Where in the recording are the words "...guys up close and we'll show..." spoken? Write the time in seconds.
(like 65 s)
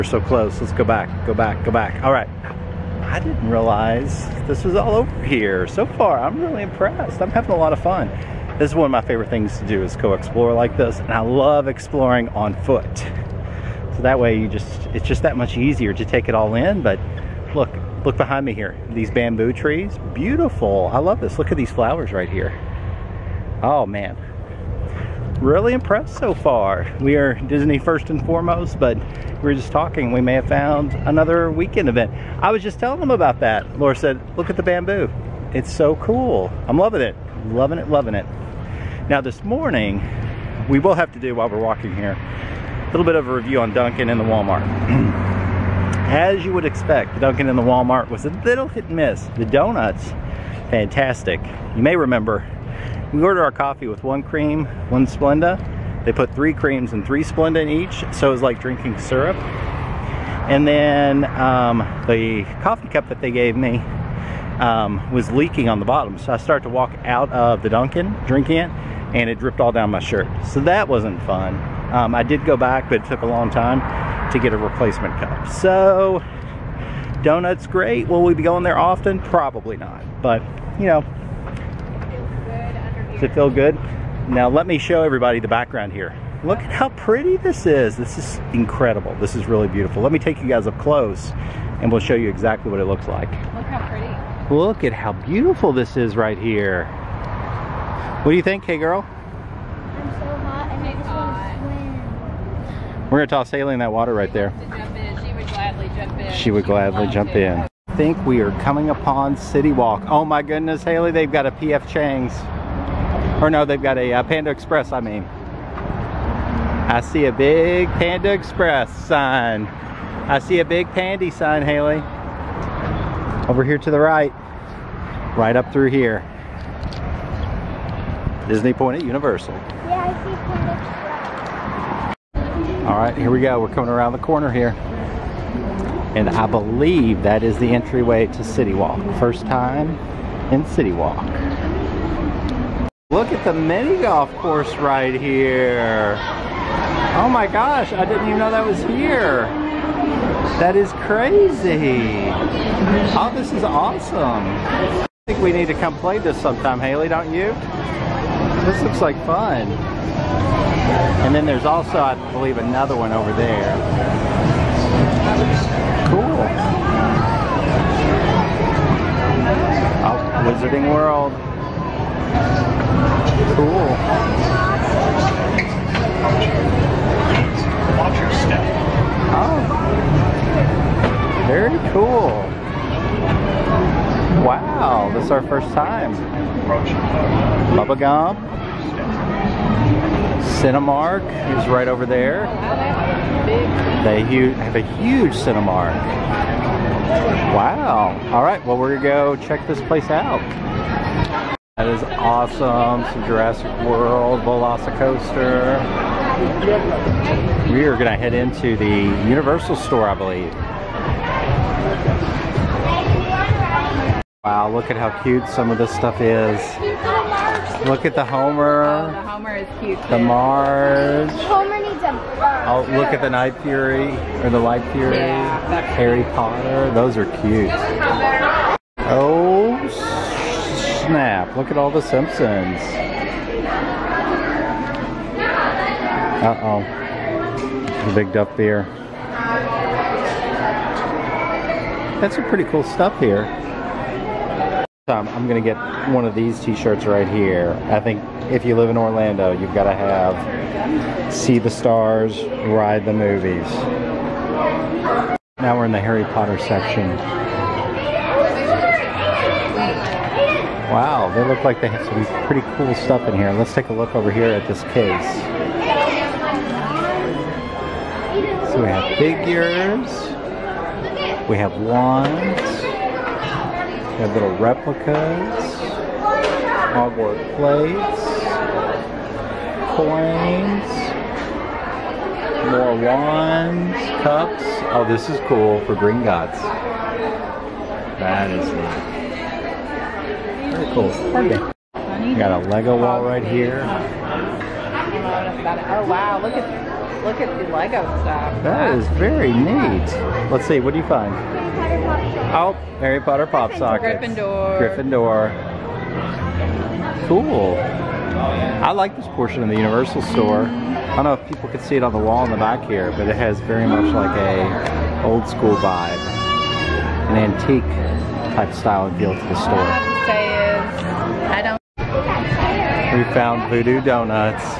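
90 s.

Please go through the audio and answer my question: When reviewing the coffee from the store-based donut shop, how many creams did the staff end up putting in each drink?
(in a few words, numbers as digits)
3.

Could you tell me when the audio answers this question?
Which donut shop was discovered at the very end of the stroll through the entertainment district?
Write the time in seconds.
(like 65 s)
323 s.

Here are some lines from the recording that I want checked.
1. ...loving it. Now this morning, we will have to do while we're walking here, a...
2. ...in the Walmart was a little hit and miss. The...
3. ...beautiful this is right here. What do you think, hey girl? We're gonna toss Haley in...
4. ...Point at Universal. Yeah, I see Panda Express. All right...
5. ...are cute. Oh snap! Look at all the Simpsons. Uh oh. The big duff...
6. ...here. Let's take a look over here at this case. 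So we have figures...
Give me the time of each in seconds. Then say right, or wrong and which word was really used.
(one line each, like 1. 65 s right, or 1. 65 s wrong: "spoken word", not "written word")
1. 37 s right
2. 47 s right
3. 95 s right
4. 128 s right
5. 227 s right
6. 263 s right.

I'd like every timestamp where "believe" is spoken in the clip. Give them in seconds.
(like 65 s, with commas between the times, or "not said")
136 s, 162 s, 210 s.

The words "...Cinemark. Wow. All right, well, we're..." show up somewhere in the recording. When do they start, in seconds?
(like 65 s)
195 s.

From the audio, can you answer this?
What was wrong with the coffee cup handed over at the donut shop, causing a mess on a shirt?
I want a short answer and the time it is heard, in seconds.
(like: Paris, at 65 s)
Leaking on the bottom, at 65 s.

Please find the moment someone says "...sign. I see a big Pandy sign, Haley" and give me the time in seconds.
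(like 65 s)
119 s.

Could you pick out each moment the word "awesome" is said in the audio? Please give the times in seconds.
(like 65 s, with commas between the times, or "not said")
153 s, 202 s.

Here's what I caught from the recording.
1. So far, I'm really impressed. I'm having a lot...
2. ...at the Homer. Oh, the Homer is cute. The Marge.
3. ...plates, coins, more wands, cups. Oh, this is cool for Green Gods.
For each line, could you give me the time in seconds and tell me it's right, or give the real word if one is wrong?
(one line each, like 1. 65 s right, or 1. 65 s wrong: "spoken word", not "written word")
1. 5 s right
2. 218 s right
3. 277 s right.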